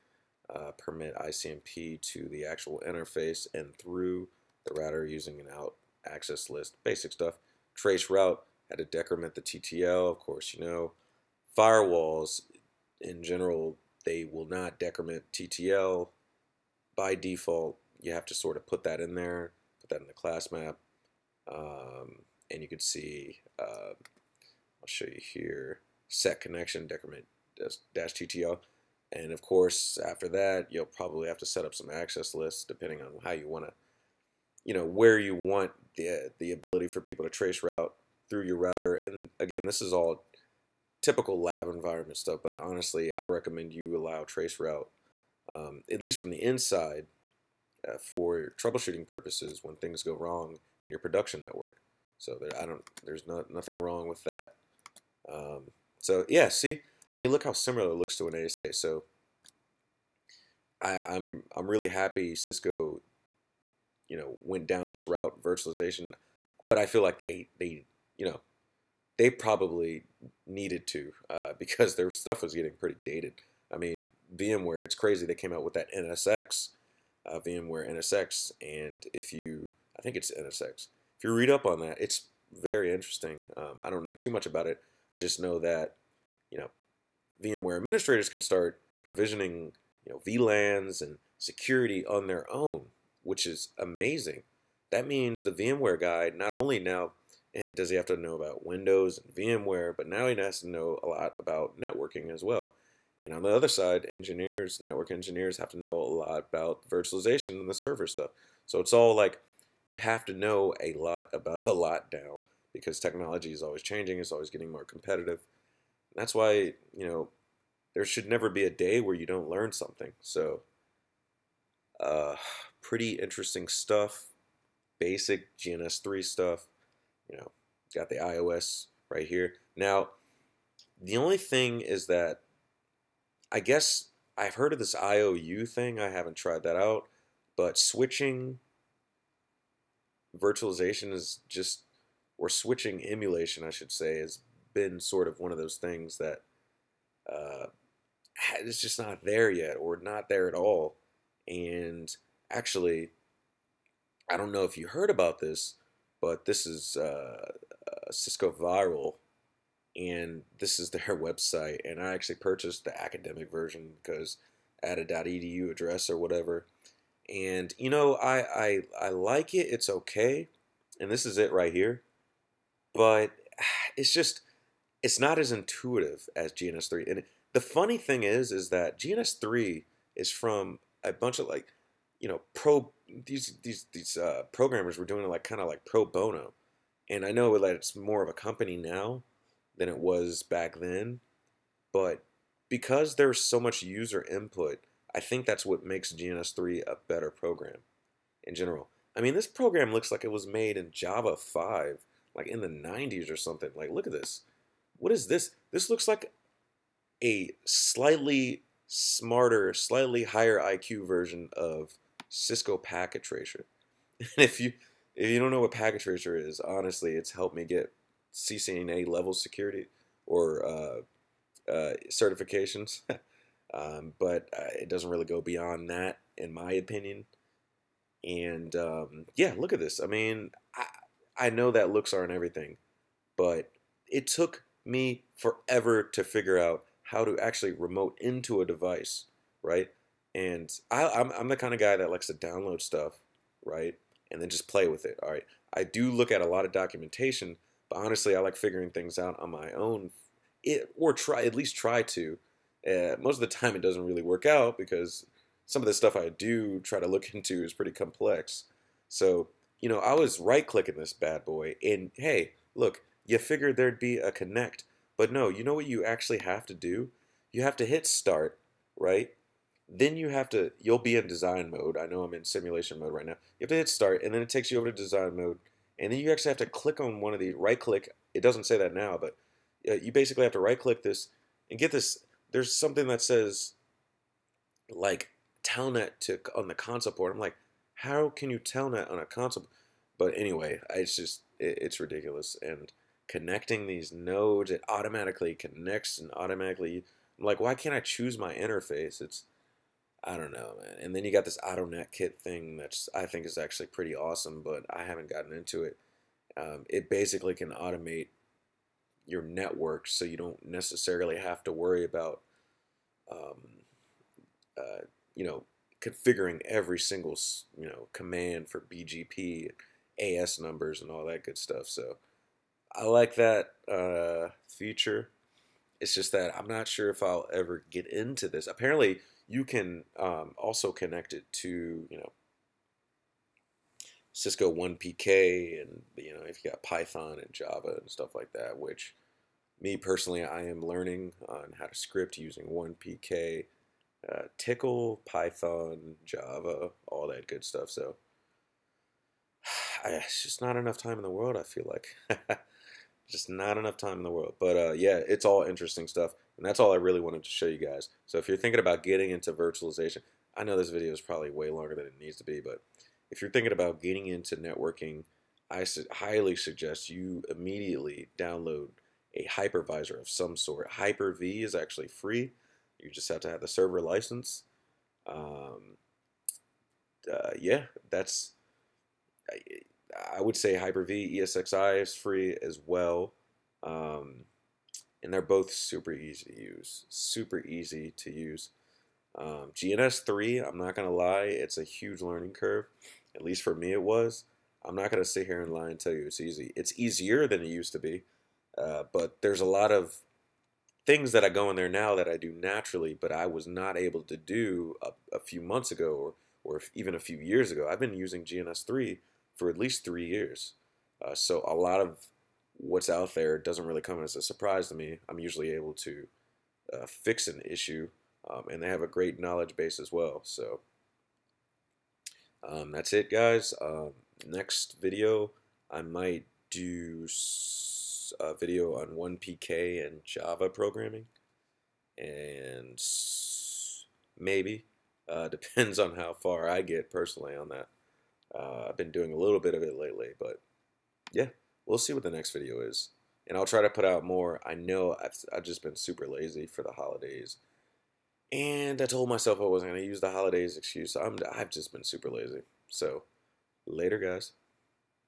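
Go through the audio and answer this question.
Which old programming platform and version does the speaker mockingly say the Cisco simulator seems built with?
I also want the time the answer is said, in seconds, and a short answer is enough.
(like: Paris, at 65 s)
Java 5, at 200 s.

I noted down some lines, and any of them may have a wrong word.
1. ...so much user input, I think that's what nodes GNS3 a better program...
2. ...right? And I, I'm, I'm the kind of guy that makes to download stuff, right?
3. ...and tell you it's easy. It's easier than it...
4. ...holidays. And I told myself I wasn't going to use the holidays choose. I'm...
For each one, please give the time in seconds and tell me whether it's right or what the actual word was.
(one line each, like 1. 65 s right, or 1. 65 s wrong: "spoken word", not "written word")
1. 193 s wrong: "makes", not "nodes"
2. 239 s wrong: "likes", not "makes"
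3. 395 s right
4. 446 s wrong: "excuse", not "choose".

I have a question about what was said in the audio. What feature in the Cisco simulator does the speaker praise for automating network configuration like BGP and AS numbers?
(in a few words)
net kit.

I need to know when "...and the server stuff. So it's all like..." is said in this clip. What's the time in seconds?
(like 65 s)
107 s.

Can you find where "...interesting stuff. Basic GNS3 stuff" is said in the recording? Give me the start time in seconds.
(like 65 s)
123 s.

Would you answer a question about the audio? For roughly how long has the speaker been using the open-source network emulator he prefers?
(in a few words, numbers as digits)
3 years.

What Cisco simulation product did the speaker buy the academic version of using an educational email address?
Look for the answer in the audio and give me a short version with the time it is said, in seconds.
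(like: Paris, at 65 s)
VIRL, at 158 s.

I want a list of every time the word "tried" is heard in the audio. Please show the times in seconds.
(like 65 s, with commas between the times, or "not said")
136 s.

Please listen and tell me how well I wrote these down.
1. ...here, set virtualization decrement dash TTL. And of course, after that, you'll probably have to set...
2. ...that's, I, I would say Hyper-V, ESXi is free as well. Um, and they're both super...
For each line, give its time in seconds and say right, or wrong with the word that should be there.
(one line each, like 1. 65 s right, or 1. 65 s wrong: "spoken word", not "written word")
1. 25 s wrong: "connection", not "virtualization"
2. 378 s right.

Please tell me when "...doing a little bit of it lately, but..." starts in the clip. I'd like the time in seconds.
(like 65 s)
439 s.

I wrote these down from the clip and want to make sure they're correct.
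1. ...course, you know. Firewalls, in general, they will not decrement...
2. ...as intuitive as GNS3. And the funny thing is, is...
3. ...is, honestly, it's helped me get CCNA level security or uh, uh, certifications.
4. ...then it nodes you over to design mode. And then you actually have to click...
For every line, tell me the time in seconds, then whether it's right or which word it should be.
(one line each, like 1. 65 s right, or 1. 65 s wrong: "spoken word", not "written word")
1. 10 s right
2. 175 s right
3. 216 s right
4. 274 s wrong: "takes", not "nodes".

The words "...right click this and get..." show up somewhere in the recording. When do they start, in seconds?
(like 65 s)
280 s.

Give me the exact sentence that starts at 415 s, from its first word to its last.
I'm usually able to uh, fix an issue, um, and they have a great knowledge base as well.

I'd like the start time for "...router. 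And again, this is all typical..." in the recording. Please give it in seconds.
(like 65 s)
38 s.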